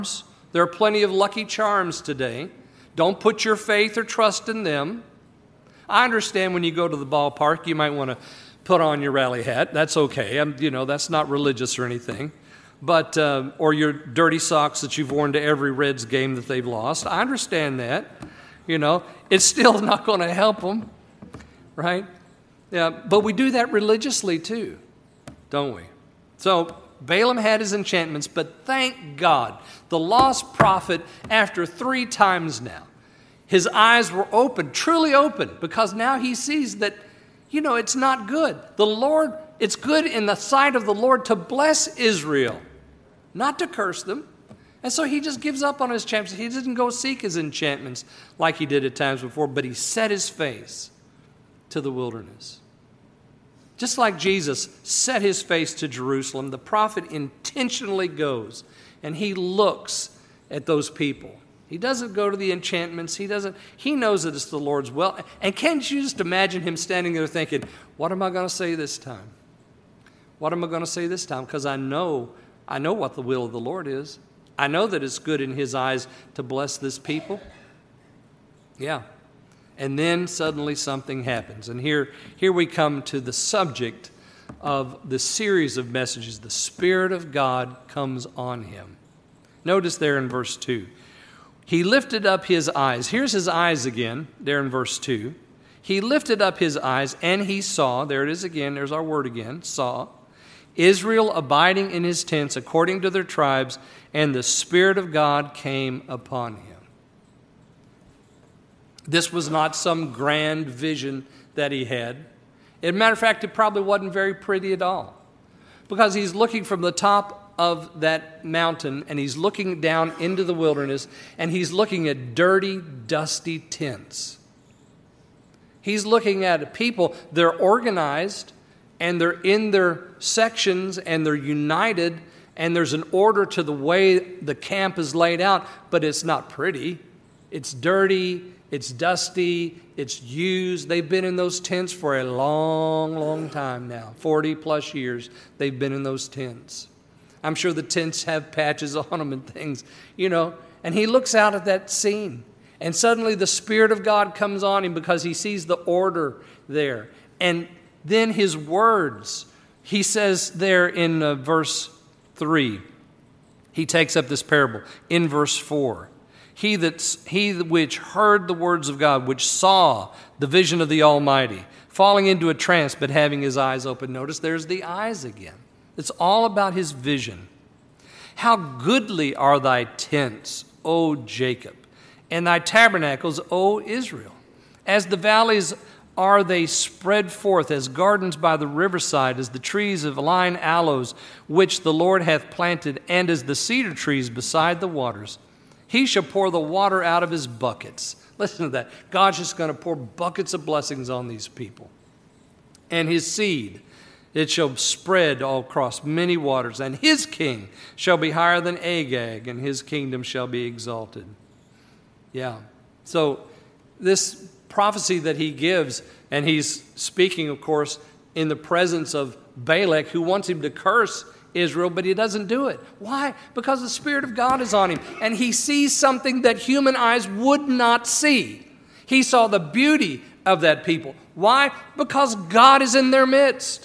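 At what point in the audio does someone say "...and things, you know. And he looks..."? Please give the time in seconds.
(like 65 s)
149 s.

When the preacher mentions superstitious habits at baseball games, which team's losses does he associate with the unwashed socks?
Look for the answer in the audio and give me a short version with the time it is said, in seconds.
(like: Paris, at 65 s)
Reds, at 15 s.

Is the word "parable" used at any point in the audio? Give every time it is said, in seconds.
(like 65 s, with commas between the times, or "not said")
164 s.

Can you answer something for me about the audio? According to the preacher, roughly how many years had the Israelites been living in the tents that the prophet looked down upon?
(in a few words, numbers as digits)
40 plus.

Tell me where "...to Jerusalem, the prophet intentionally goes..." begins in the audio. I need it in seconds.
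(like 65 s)
55 s.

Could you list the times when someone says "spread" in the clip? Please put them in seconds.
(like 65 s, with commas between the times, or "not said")
186 s, 204 s.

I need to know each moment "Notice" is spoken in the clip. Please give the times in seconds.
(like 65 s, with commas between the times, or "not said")
89 s, 174 s.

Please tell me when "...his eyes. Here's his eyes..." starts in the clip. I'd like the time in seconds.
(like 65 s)
92 s.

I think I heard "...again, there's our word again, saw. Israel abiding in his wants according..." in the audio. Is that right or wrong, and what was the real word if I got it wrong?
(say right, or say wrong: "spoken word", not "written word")
wrong: "tents", not "wants".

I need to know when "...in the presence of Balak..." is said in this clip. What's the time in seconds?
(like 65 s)
218 s.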